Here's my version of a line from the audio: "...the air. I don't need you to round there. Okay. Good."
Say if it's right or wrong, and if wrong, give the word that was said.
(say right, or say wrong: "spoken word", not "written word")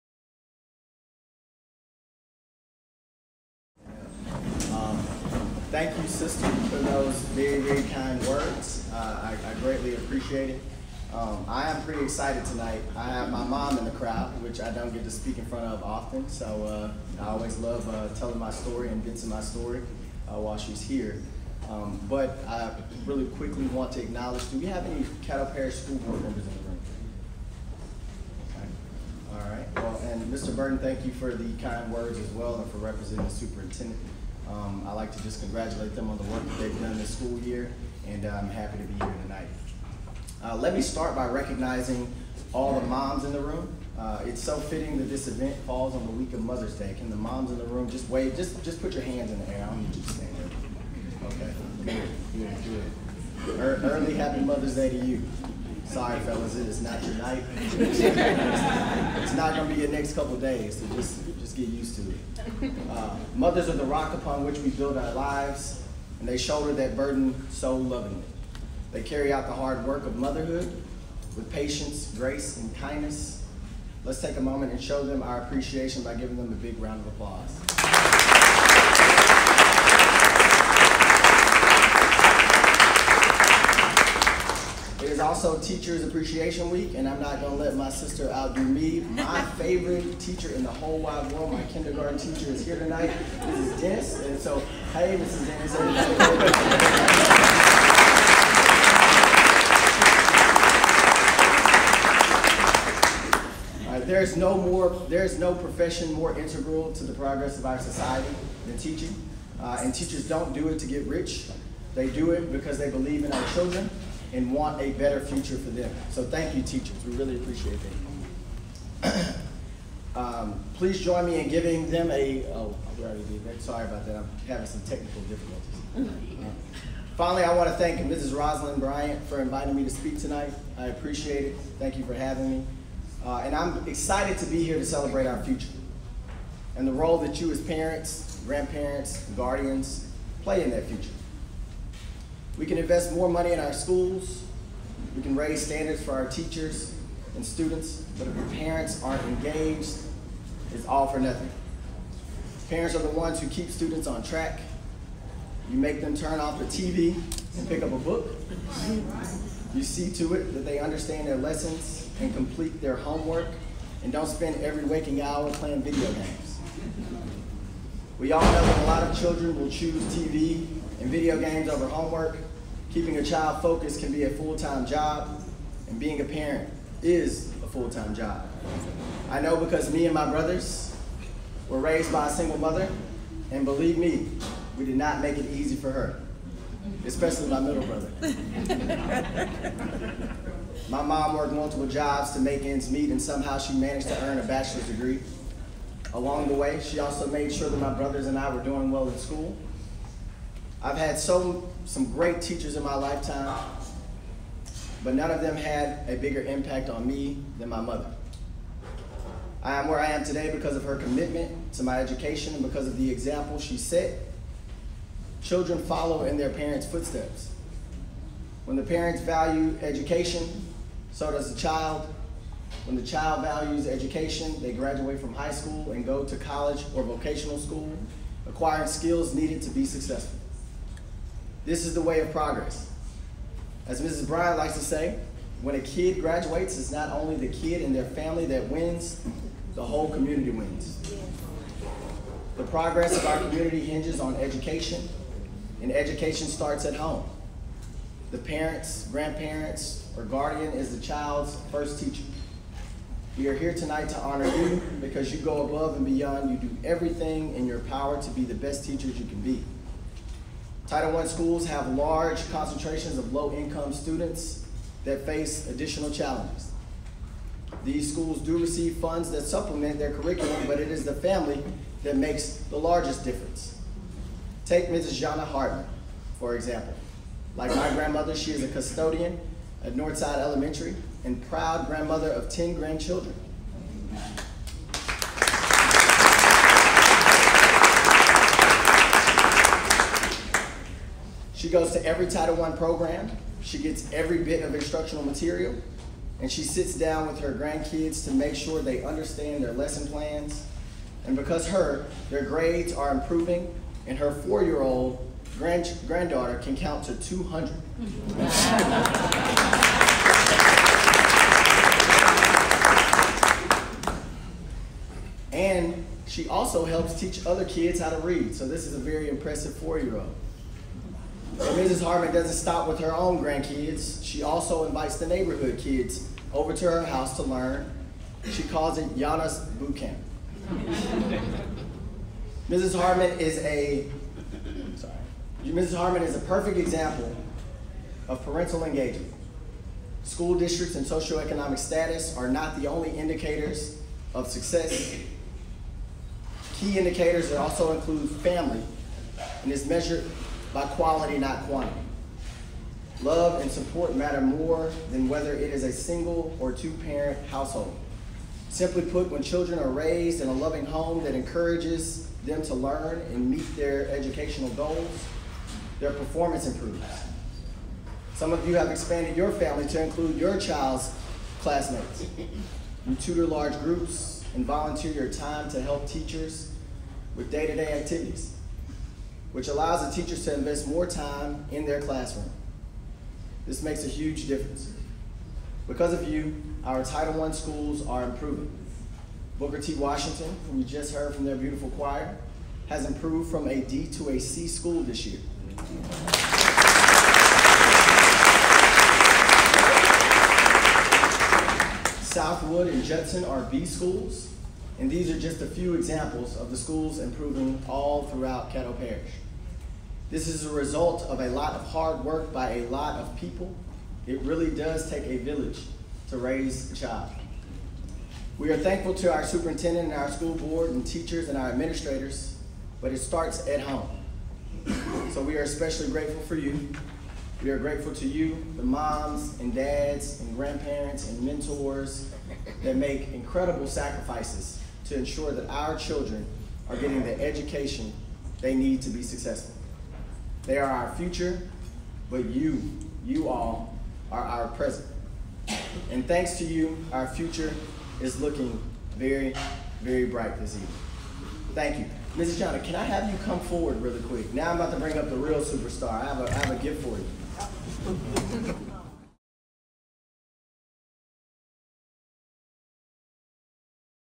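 wrong: "stand", not "round".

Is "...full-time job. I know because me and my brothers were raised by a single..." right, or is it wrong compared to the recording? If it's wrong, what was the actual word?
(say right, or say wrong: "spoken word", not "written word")
right.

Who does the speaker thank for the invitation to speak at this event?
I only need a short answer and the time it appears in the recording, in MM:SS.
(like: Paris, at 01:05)
Mrs. Rosalind Bryant, at 02:07.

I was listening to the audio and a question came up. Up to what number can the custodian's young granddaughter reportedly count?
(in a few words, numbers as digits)
200.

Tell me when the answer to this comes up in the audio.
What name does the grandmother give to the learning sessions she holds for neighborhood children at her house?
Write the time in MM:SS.
05:29.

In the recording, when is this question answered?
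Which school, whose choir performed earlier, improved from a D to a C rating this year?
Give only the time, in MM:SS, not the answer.
06:29.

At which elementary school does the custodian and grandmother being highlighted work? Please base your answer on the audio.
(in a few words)
Northside Elementary.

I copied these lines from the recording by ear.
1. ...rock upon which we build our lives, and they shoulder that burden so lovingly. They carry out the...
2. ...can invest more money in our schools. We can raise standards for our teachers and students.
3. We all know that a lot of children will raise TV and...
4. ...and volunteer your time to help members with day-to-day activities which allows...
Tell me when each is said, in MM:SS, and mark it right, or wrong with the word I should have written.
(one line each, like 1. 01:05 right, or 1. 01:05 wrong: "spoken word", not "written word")
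1. 01:03 right
2. 02:22 right
3. 02:48 wrong: "choose", not "raise"
4. 06:14 wrong: "teachers", not "members".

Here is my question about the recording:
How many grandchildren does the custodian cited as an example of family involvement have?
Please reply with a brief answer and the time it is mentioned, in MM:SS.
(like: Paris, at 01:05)
10, at 04:42.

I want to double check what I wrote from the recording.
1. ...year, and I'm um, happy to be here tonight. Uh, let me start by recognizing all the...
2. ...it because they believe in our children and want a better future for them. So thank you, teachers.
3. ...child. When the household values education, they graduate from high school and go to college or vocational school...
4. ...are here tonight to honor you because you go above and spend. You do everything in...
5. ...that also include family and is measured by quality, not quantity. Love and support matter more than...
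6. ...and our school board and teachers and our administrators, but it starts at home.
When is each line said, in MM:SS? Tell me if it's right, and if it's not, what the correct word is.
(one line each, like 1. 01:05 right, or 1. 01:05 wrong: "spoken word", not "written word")
1. 00:37 right
2. 01:52 right
3. 03:41 wrong: "child", not "household"
4. 04:13 wrong: "beyond", not "spend"
5. 05:47 right
6. 07:00 right.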